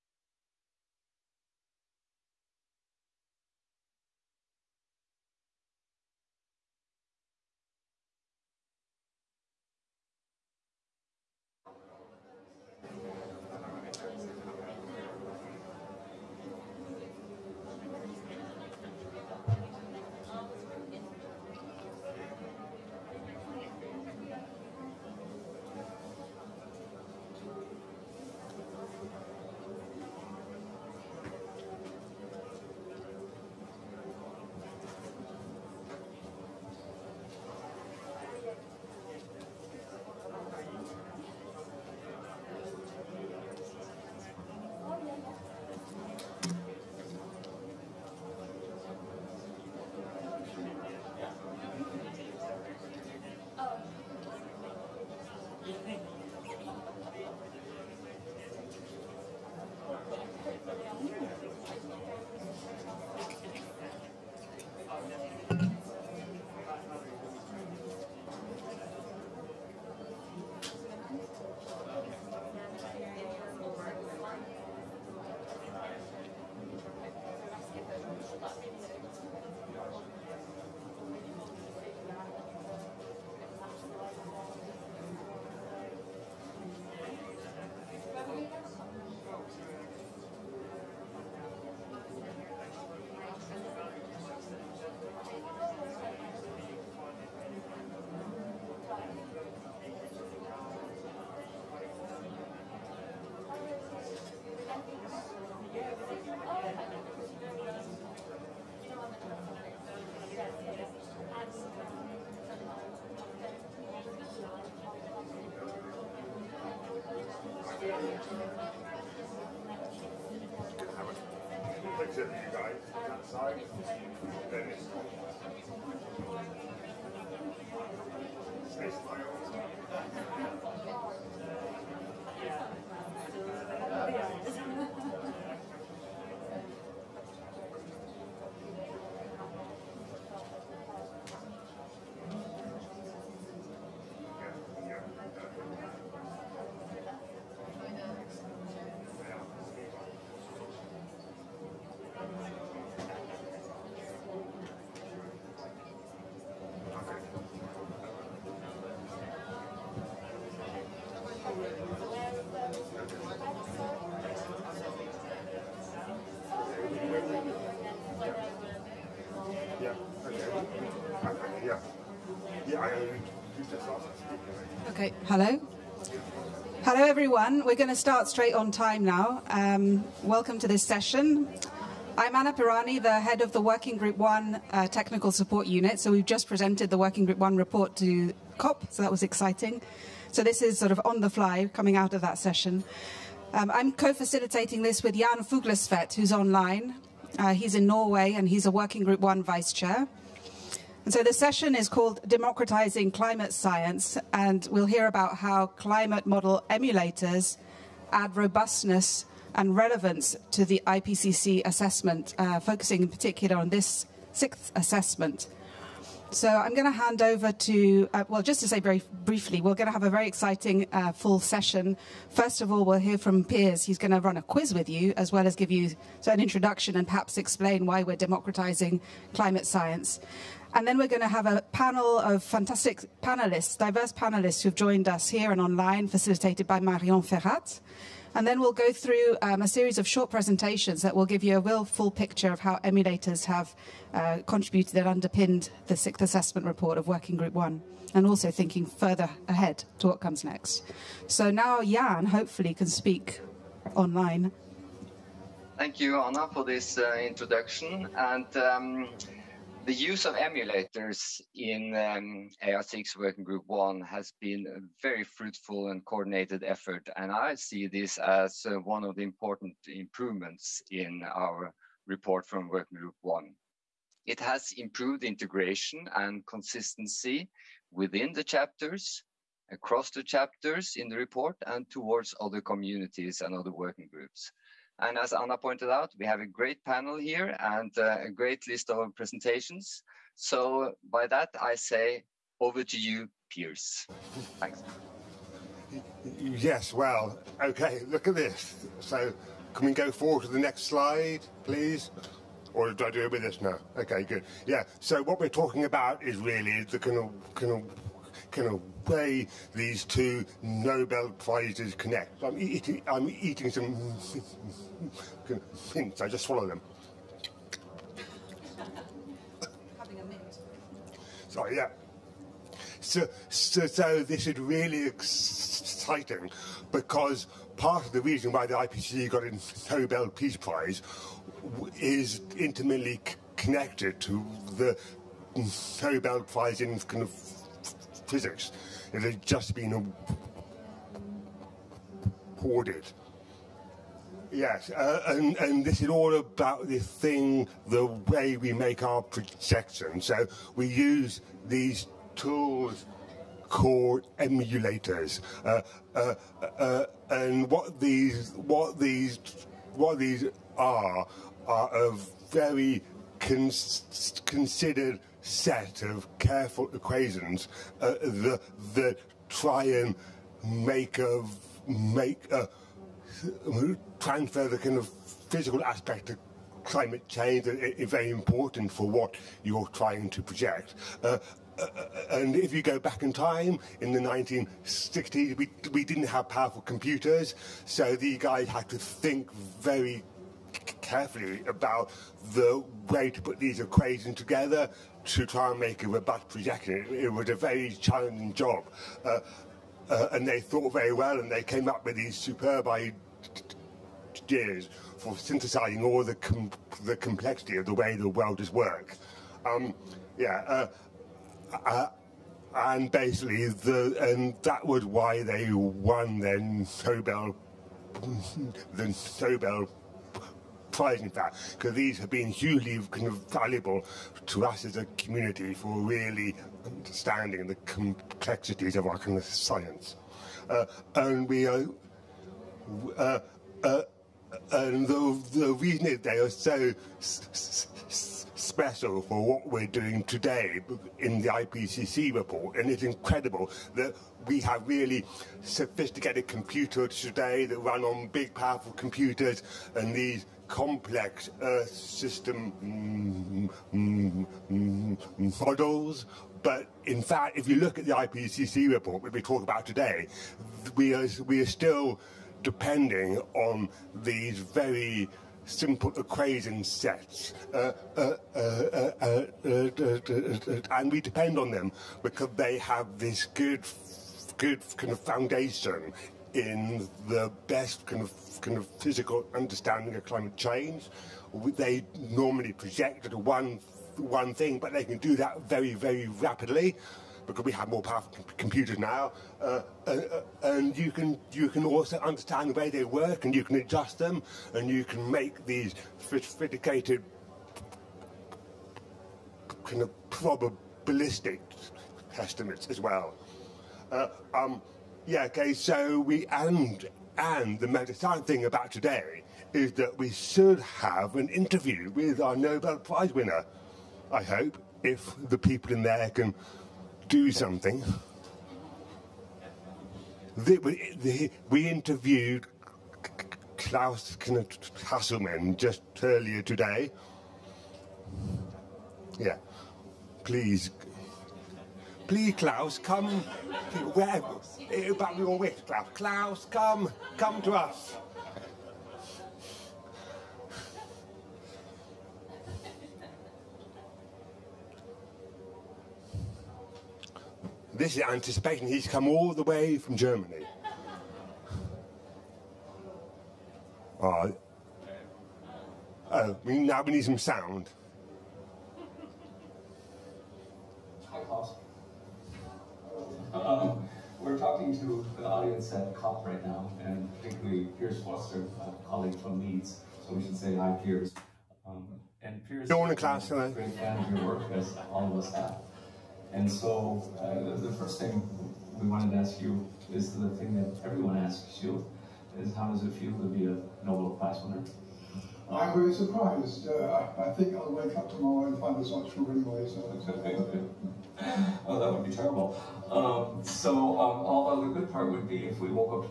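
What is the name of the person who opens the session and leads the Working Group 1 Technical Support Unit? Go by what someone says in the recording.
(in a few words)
Anna Pirani.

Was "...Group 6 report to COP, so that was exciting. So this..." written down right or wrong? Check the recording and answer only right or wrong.
wrong.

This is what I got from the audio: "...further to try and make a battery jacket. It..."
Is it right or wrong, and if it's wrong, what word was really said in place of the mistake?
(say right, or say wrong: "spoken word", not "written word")
wrong: "together", not "further".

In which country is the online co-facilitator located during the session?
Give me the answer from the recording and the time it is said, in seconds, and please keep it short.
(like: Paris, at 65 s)
Norway, at 197 s.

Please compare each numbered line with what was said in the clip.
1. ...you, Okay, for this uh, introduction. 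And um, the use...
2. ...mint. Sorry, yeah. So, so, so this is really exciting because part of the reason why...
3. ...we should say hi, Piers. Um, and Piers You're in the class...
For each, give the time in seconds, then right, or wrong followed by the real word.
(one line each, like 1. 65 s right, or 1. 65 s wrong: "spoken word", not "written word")
1. 256 s wrong: "Anna", not "Okay"
2. 320 s right
3. 570 s right.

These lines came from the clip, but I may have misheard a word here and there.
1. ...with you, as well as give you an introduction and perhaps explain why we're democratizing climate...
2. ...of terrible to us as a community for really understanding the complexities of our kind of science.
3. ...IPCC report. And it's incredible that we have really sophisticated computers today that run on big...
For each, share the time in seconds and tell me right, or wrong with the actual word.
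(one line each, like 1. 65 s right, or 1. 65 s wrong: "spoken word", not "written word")
1. 224 s right
2. 423 s wrong: "valuable", not "terrible"
3. 441 s right.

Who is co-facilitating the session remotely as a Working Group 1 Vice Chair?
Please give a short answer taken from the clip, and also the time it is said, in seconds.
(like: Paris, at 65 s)
Jan Fuglestvedt, at 195 s.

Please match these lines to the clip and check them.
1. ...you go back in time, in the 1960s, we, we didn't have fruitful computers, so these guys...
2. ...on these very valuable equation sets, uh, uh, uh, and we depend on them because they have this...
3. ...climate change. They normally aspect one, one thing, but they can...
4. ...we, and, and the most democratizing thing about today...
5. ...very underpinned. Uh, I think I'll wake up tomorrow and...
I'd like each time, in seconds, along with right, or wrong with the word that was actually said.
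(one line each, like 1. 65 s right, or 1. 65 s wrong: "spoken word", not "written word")
1. 382 s wrong: "powerful", not "fruitful"
2. 463 s wrong: "simple", not "valuable"
3. 480 s wrong: "project", not "aspect"
4. 506 s wrong: "exciting", not "democratizing"
5. 585 s wrong: "surprised", not "underpinned".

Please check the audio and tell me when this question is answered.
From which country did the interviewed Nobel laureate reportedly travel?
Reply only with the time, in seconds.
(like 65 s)
550 s.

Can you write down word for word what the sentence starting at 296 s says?
Yes, well, okay, look at this.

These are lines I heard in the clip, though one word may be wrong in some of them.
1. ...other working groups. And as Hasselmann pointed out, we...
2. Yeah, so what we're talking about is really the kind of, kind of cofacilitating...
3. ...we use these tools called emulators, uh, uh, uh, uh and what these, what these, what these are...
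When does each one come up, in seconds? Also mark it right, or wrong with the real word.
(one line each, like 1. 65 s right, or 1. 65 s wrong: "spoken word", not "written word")
1. 283 s wrong: "Anna", not "Hasselmann"
2. 304 s wrong: "fucking", not "cofacilitating"
3. 350 s right.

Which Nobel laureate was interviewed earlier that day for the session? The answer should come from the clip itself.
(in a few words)
Klaus Hasselmann.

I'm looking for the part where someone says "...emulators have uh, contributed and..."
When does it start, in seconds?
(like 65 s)
242 s.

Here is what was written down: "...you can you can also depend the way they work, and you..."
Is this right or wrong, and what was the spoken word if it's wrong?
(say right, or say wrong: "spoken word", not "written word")
wrong: "understand", not "depend".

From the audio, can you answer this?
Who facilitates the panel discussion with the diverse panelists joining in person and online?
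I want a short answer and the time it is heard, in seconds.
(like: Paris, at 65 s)
Marion Ferrat, at 236 s.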